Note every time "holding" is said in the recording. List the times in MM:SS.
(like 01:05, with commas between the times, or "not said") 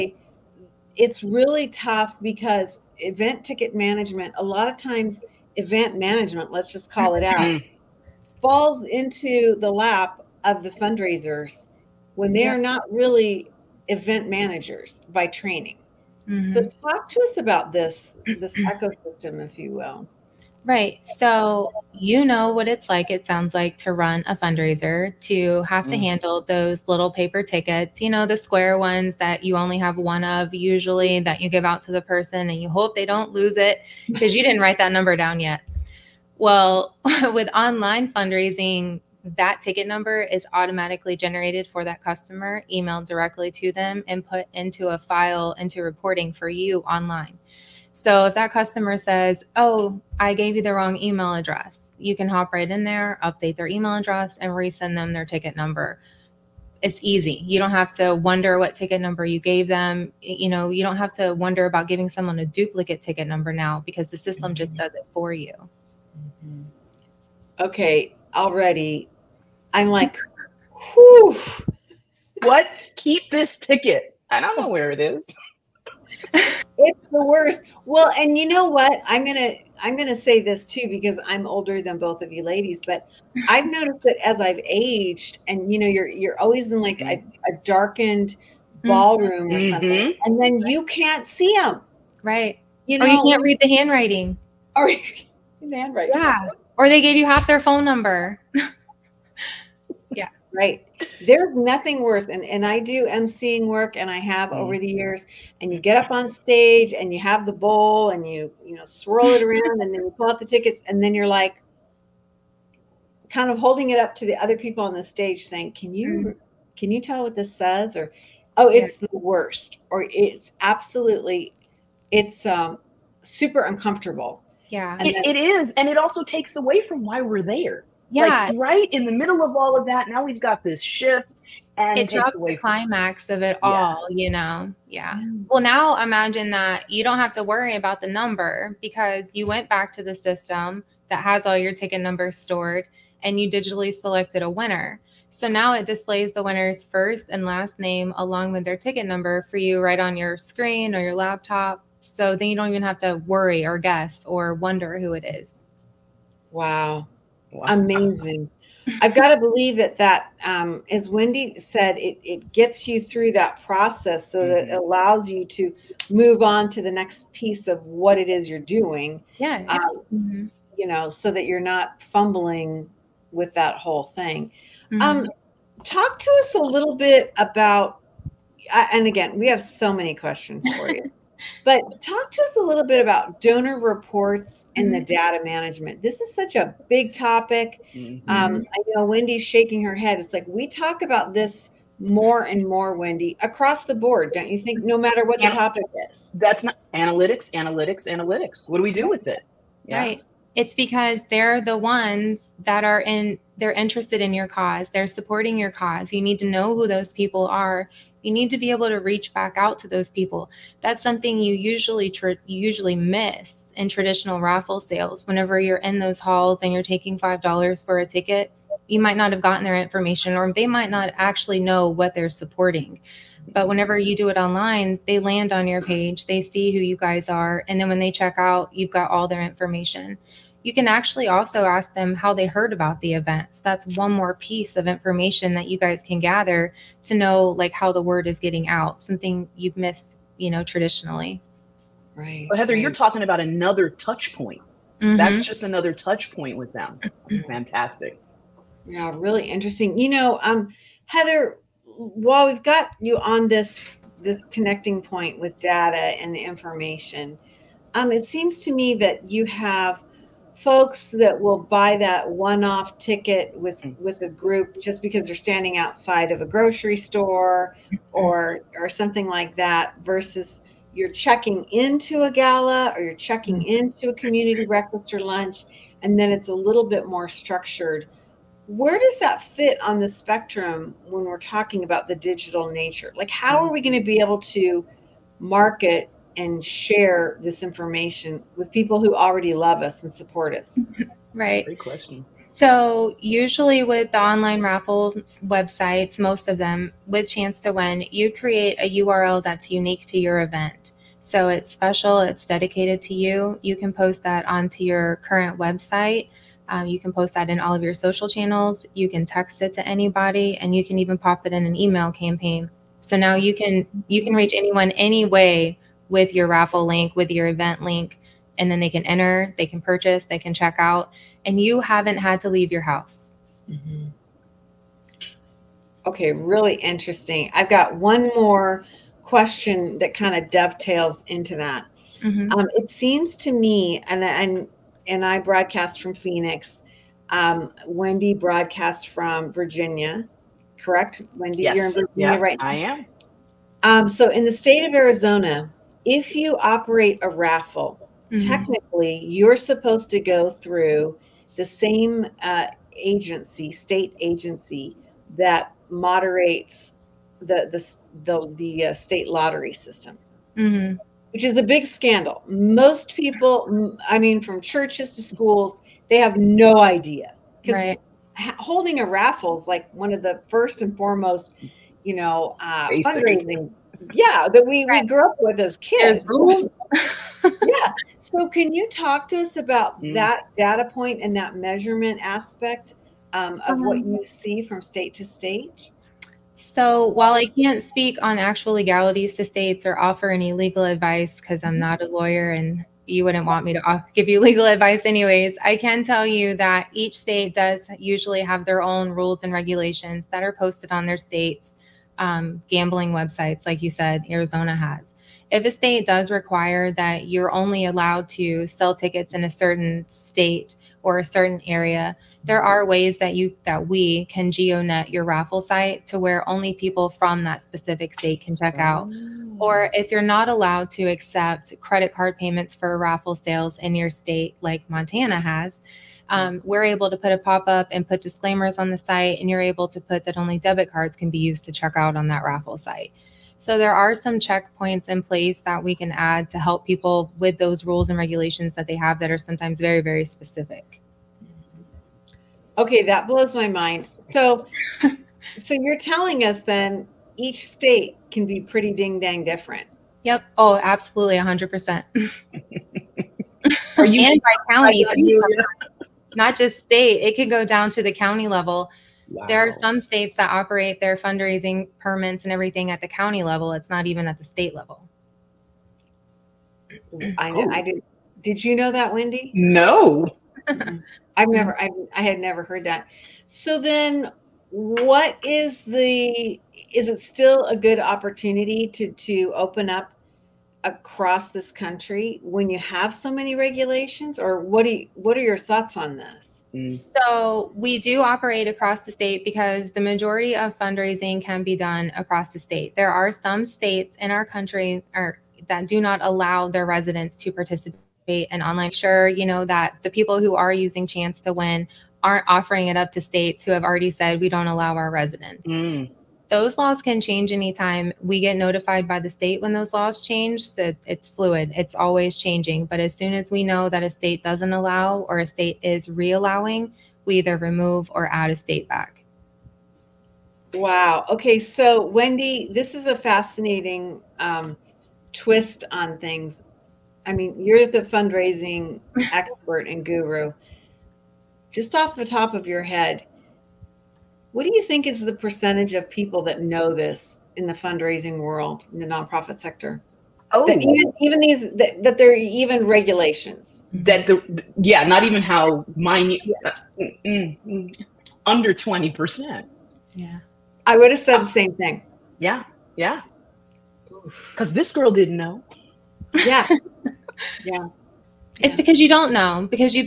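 01:53, 06:08.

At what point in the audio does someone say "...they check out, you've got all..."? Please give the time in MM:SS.
03:47.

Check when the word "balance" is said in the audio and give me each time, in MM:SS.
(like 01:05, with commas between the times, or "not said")
not said.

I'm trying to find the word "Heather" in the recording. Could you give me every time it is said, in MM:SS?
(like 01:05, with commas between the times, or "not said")
04:02, 04:11.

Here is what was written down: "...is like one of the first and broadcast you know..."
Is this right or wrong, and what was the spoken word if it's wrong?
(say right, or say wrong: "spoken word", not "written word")
wrong: "foremost", not "broadcast".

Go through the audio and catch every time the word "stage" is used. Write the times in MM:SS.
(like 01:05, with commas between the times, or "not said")
01:46, 01:55.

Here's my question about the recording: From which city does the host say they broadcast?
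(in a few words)
Phoenix.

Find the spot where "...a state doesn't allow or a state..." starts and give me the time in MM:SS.
08:34.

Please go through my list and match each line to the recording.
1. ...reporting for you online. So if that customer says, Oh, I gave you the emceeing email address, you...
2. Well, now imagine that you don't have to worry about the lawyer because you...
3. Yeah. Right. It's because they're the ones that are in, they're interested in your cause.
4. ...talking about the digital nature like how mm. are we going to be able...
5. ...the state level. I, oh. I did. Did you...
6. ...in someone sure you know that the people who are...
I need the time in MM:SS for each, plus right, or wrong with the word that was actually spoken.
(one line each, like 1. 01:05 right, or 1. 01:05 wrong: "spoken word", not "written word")
1. 00:45 wrong: "wrong", not "emceeing"
2. 02:15 wrong: "number", not "lawyer"
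3. 03:19 right
4. 04:41 right
5. 07:44 right
6. 08:18 wrong: "online", not "someone".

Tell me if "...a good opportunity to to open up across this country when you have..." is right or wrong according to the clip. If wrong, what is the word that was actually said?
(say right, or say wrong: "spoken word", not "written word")
right.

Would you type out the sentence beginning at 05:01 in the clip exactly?
So, it's special, it's dedicated to you.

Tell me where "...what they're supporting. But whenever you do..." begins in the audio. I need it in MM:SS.
03:41.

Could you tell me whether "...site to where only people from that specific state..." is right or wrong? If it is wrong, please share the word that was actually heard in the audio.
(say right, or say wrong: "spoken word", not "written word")
right.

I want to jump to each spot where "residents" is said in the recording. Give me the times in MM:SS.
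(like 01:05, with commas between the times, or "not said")
08:16, 08:25.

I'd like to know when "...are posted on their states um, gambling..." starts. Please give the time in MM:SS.
06:40.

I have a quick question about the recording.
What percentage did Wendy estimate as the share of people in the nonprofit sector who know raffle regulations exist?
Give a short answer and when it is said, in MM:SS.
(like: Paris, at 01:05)
under 20%, at 09:08.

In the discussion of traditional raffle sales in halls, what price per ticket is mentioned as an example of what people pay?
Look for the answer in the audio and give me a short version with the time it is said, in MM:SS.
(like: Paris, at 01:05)
$5, at 03:37.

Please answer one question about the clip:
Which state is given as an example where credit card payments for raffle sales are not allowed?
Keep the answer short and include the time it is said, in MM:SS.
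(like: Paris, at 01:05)
Montana, at 07:04.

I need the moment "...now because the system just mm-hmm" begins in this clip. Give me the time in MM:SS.
01:03.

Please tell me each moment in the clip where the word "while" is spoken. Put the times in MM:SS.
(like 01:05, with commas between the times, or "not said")
04:11, 06:27.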